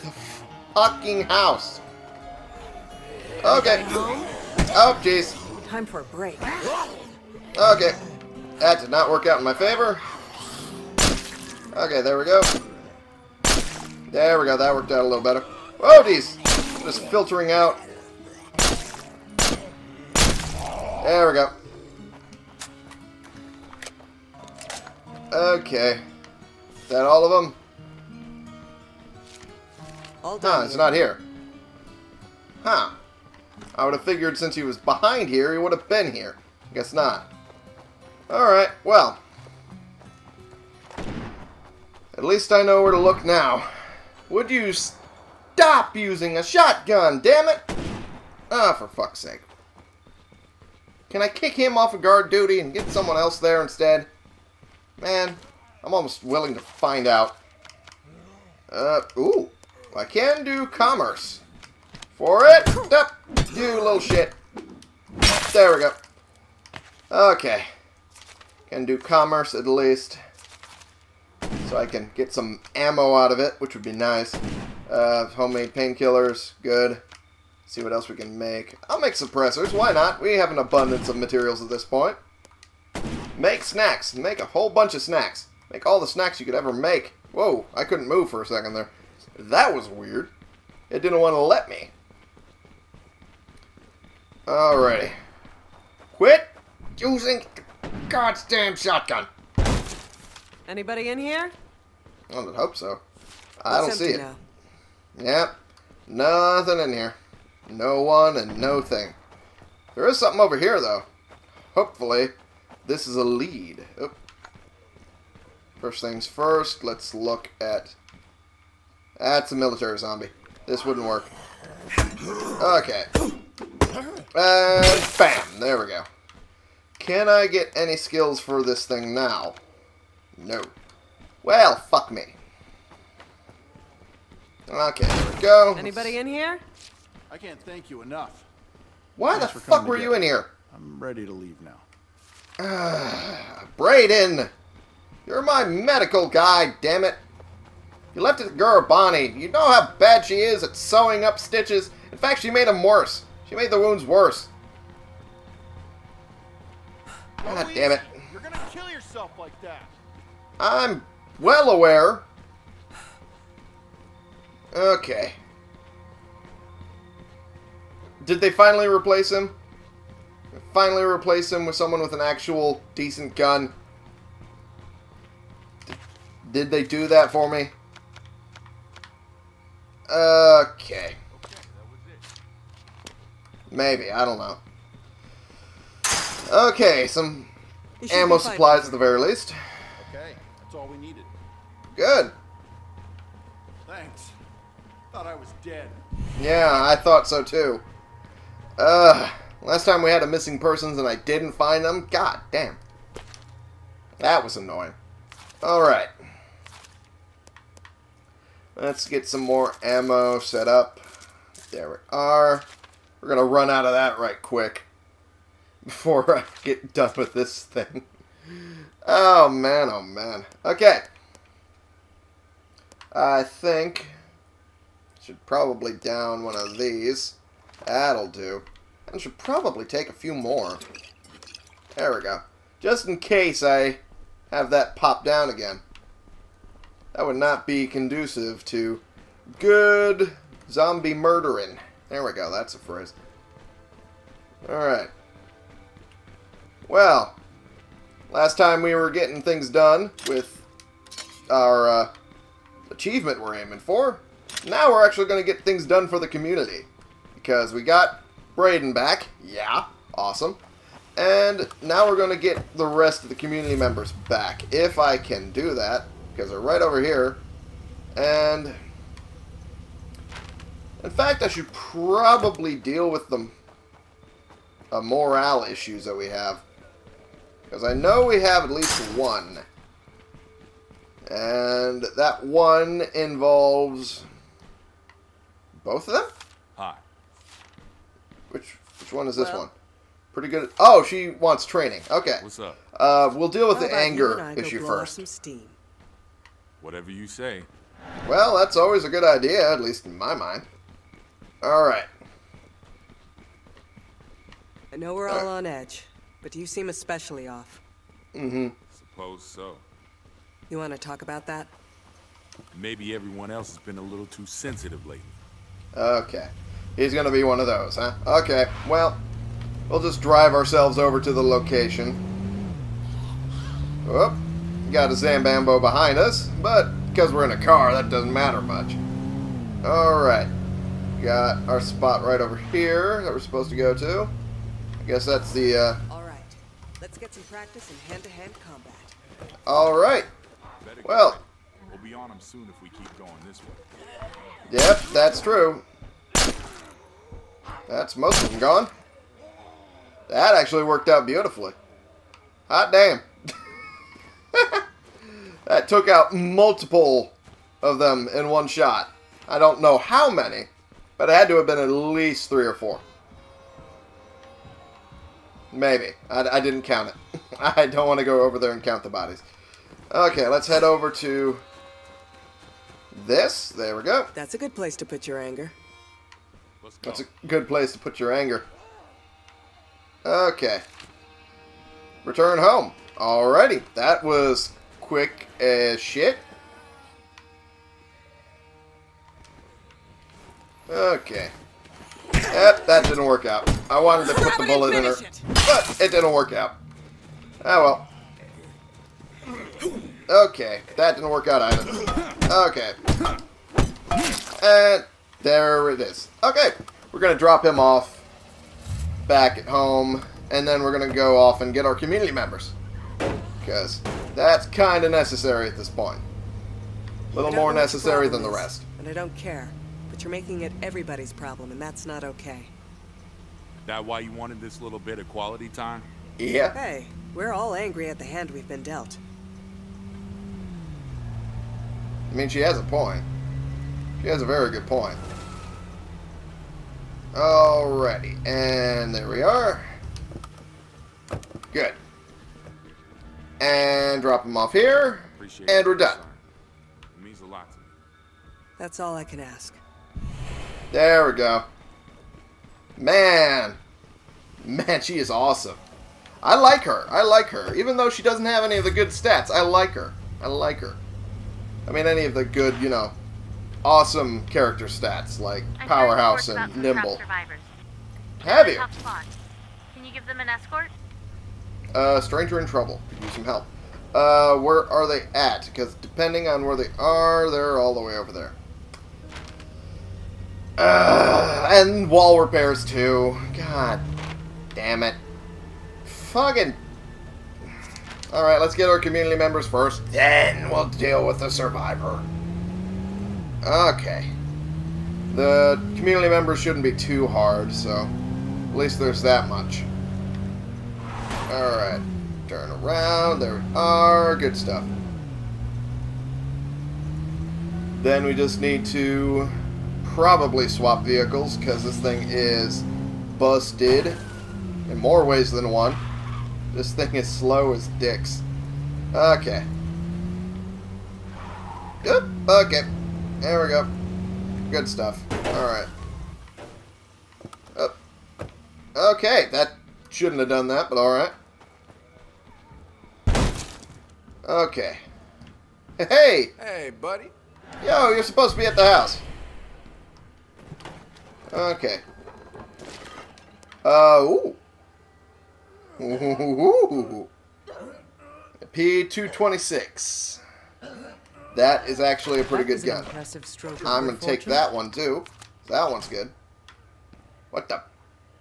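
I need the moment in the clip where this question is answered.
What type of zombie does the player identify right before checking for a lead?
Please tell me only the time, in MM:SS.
01:59.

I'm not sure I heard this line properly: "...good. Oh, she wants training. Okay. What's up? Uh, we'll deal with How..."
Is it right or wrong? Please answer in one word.
right.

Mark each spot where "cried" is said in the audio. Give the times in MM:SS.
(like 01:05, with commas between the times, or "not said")
not said.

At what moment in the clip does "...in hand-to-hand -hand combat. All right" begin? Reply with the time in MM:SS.
05:37.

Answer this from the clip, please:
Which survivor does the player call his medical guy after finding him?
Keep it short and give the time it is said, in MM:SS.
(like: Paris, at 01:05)
Brayden, at 02:23.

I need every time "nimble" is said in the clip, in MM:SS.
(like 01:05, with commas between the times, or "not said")
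07:46.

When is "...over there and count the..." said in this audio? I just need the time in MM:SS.
06:08.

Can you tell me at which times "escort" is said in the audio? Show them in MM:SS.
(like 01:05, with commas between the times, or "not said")
07:50.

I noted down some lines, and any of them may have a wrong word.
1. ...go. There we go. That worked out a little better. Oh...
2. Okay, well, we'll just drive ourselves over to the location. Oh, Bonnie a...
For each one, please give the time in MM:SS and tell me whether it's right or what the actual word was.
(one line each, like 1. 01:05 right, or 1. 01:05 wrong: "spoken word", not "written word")
1. 00:12 right
2. 05:18 wrong: "Got", not "Bonnie".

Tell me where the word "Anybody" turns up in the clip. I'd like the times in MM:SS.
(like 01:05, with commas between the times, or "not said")
01:40, 02:15.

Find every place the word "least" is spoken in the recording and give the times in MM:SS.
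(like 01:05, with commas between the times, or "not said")
00:42, 01:09, 03:09, 04:38, 04:59, 06:01, 08:18.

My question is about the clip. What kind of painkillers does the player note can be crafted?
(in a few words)
Homemade.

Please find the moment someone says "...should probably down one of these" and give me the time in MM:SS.
03:45.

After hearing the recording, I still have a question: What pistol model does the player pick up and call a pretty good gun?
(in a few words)
P226.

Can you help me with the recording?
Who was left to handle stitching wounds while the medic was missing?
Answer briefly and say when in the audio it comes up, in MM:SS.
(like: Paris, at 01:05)
Bonnie, at 02:28.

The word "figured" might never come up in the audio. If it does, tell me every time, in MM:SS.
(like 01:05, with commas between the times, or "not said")
00:34.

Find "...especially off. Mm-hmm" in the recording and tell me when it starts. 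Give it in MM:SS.
05:06.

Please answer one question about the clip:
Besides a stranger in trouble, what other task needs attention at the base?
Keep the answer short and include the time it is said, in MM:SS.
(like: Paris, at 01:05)
Wall repairs, at 08:02.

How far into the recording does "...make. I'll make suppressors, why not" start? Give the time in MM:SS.
01:18.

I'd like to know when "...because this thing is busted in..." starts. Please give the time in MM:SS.
08:31.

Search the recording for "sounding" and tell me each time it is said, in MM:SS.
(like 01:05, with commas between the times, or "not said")
not said.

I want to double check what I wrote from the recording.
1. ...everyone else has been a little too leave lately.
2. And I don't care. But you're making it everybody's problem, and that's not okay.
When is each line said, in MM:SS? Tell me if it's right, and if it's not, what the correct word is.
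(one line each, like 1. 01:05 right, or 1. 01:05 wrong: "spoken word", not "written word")
1. 05:13 wrong: "sensitive", not "leave"
2. 06:58 right.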